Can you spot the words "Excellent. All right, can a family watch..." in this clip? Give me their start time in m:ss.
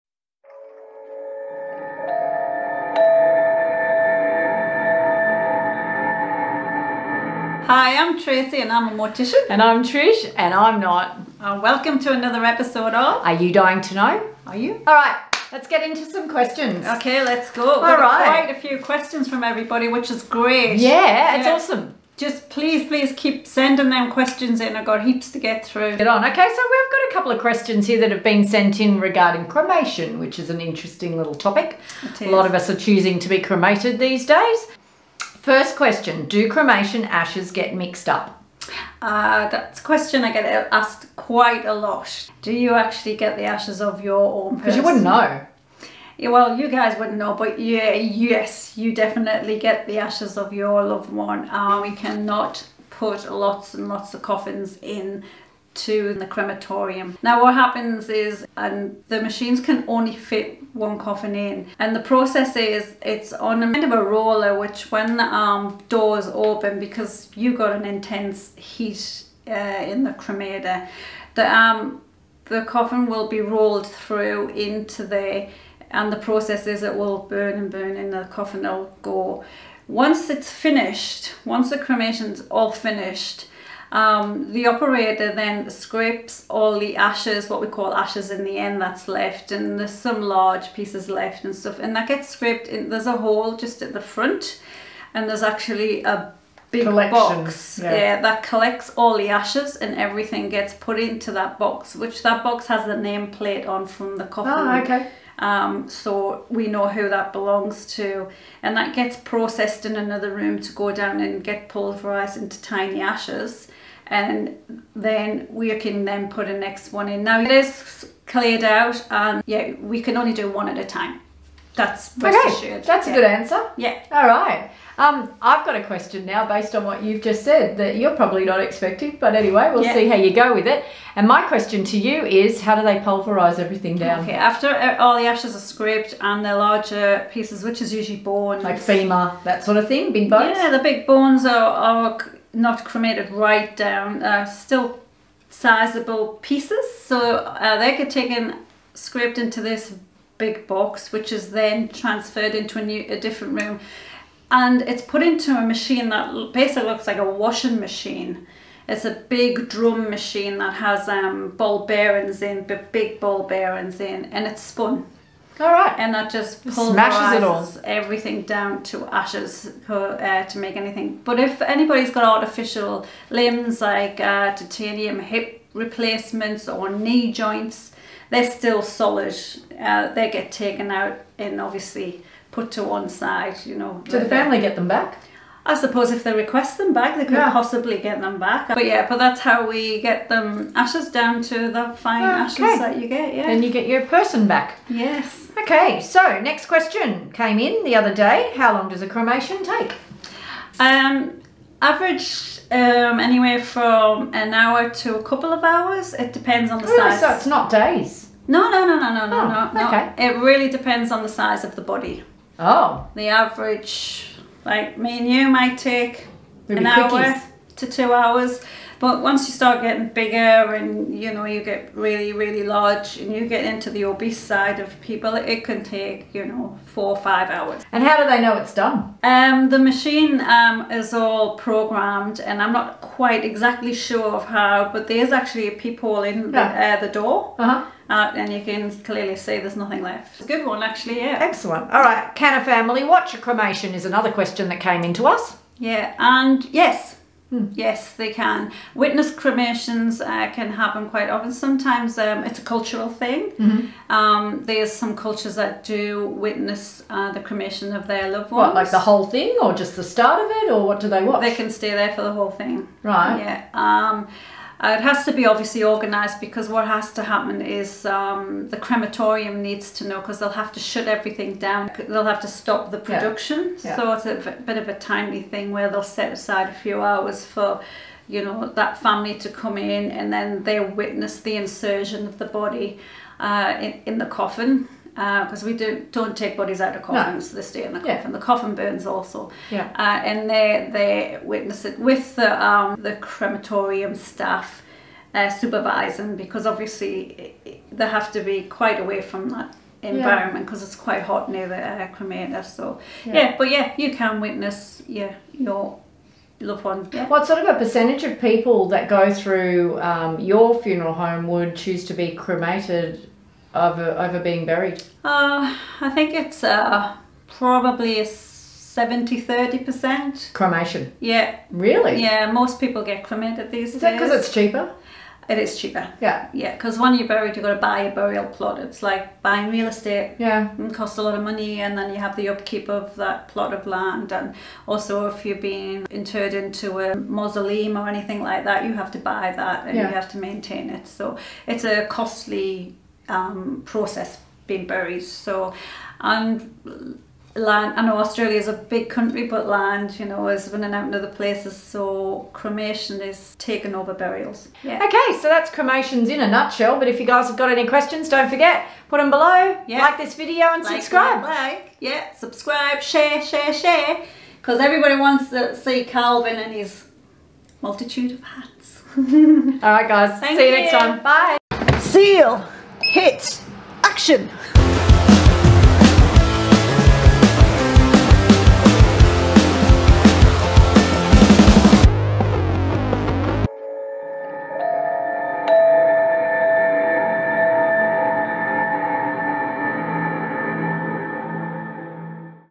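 4:01.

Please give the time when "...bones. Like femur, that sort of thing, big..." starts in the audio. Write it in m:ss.
2:18.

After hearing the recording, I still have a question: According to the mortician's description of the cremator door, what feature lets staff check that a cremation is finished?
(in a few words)
peephole.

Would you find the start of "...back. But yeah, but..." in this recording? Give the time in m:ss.
3:08.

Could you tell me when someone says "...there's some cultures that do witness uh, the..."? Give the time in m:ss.
4:14.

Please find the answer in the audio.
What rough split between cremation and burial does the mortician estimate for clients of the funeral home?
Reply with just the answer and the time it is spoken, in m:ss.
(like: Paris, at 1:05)
70/30, at 5:18.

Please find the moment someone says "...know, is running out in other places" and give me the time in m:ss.
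5:50.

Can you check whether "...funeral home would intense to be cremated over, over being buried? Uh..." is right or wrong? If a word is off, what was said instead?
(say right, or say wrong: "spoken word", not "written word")
wrong: "choose", not "intense".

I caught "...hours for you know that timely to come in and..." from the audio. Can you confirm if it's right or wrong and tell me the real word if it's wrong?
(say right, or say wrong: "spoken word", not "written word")
wrong: "family", not "timely".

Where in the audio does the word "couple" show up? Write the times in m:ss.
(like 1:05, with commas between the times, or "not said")
0:27, 3:25.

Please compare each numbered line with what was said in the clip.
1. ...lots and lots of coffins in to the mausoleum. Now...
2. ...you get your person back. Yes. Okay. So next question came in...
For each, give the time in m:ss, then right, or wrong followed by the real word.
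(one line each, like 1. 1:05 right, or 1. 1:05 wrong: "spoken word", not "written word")
1. 0:53 wrong: "crematorium", not "mausoleum"
2. 3:13 right.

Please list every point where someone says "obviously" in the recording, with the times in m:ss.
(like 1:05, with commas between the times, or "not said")
3:01, 4:25, 4:56.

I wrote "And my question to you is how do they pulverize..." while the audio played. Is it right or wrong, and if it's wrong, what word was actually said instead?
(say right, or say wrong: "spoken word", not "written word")
right.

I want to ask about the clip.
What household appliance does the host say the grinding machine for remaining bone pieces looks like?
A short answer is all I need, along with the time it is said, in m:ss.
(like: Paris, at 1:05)
washing machine, at 2:37.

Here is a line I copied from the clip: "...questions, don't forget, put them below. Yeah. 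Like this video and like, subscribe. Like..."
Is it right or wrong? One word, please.
right.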